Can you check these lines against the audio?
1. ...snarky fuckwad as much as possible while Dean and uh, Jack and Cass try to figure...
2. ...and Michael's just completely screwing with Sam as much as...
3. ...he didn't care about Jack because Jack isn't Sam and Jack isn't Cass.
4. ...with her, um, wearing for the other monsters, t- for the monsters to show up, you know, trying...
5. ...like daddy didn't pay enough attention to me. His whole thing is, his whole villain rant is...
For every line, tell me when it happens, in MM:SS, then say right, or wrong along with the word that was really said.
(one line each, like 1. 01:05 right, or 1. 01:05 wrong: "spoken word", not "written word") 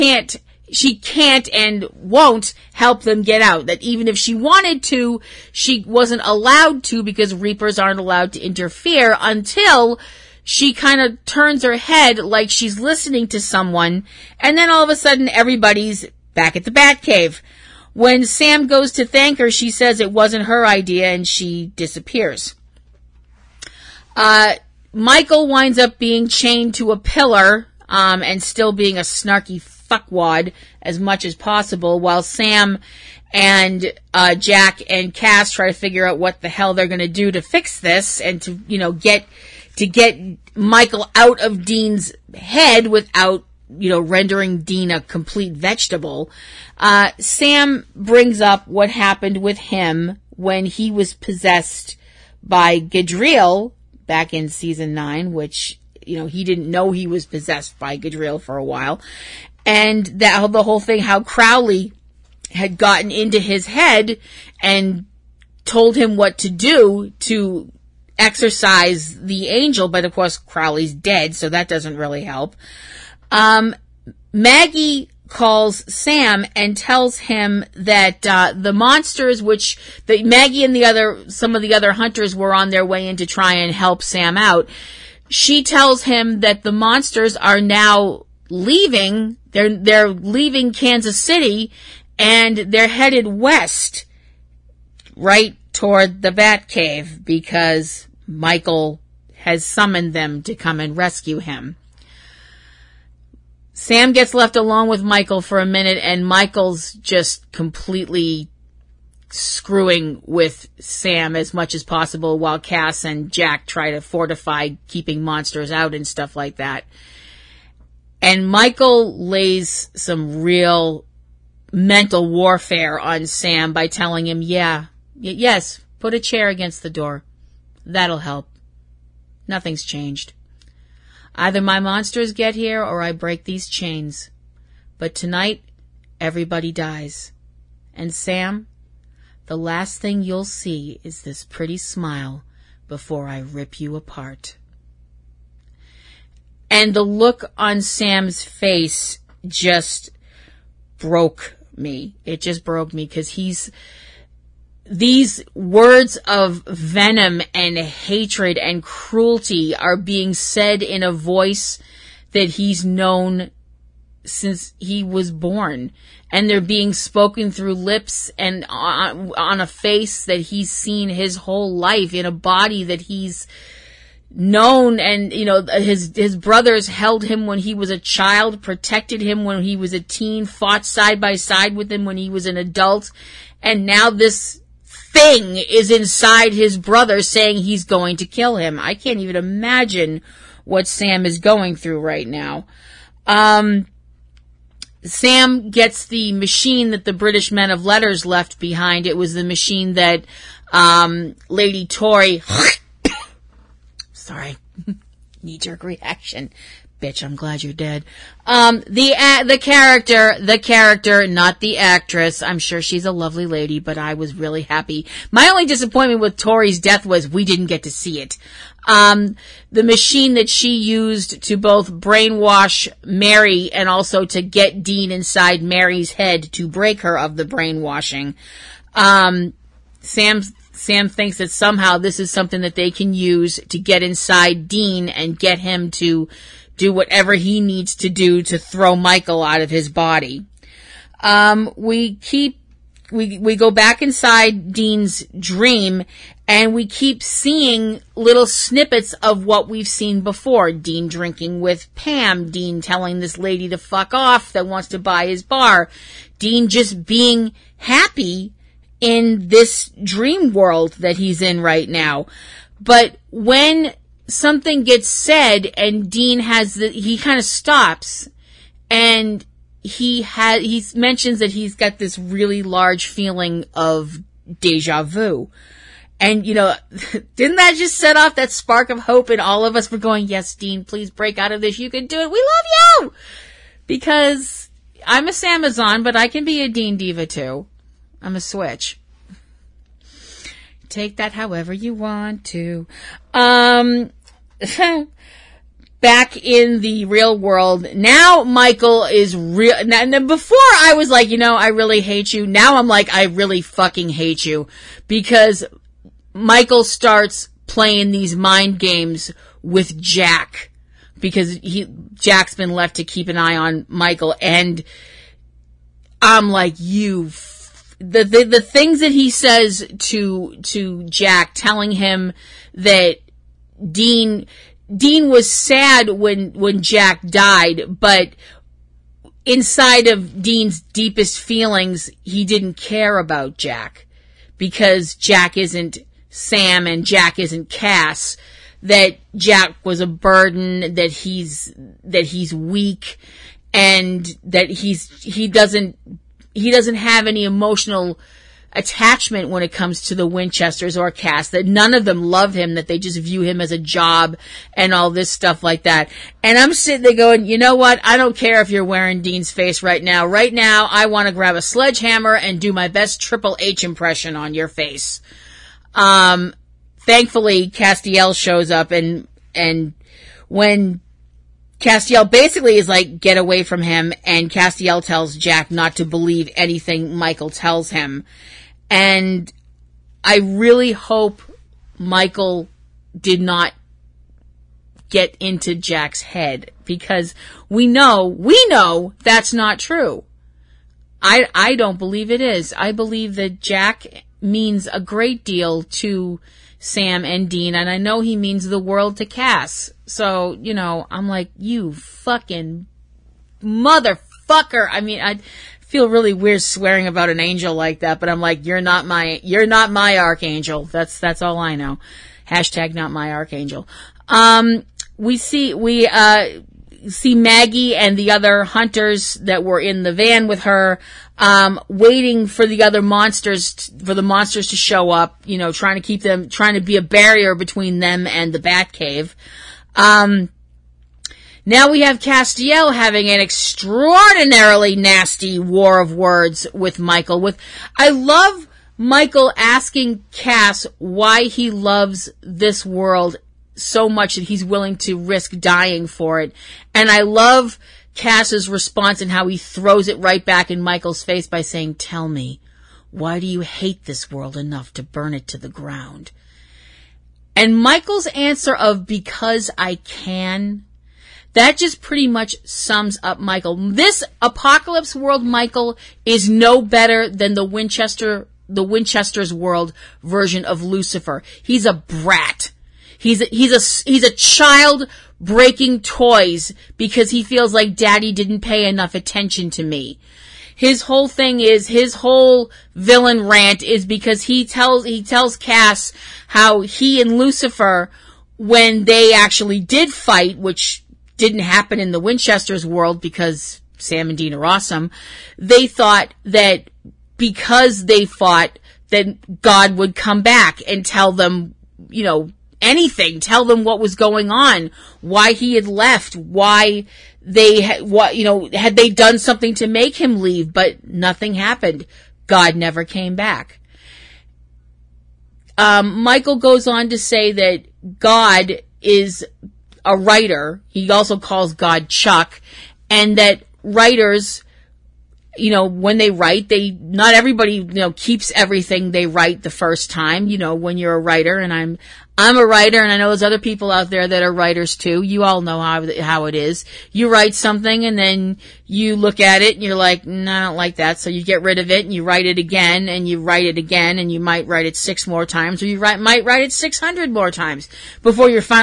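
1. 00:29 wrong: "Sam", not "Dean"
2. 01:46 right
3. 05:32 right
4. 07:00 wrong: "waiting", not "wearing"
5. 07:57 right.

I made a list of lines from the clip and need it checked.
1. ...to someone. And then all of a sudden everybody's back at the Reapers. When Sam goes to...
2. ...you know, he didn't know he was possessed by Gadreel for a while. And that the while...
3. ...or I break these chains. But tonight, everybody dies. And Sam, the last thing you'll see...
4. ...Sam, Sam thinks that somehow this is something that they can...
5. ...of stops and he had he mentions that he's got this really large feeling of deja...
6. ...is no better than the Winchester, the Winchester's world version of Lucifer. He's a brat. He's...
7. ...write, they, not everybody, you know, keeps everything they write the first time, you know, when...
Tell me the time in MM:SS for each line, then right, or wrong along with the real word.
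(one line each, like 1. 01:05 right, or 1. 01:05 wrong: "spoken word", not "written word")
1. 00:13 wrong: "Batcave", not "Reapers"
2. 00:56 wrong: "whole", not "while"
3. 02:12 right
4. 03:50 right
5. 04:27 right
6. 07:46 right
7. 08:46 right.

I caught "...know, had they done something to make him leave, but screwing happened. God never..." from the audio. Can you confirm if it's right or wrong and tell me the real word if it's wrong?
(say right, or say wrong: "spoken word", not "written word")
wrong: "nothing", not "screwing".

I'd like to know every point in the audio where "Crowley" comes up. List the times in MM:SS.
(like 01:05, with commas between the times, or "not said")
01:01, 01:10.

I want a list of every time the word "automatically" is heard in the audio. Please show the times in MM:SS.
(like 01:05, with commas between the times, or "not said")
not said.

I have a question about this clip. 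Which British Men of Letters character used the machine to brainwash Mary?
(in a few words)
Tori.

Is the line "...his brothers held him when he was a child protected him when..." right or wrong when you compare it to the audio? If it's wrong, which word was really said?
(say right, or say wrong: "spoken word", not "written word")
right.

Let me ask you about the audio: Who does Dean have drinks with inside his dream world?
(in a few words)
Pam.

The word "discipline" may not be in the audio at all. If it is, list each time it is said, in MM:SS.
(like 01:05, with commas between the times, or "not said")
not said.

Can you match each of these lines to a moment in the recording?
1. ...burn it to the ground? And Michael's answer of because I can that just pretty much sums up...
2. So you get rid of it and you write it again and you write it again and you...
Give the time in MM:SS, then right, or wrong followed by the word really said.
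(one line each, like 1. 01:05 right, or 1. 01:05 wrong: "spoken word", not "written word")
1. 07:35 right
2. 09:01 right.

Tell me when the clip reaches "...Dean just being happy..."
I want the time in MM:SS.
04:16.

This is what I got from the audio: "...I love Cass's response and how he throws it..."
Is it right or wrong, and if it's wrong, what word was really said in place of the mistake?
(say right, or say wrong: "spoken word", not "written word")
right.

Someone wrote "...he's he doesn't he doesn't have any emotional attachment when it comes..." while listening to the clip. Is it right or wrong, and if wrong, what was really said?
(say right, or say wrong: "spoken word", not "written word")
right.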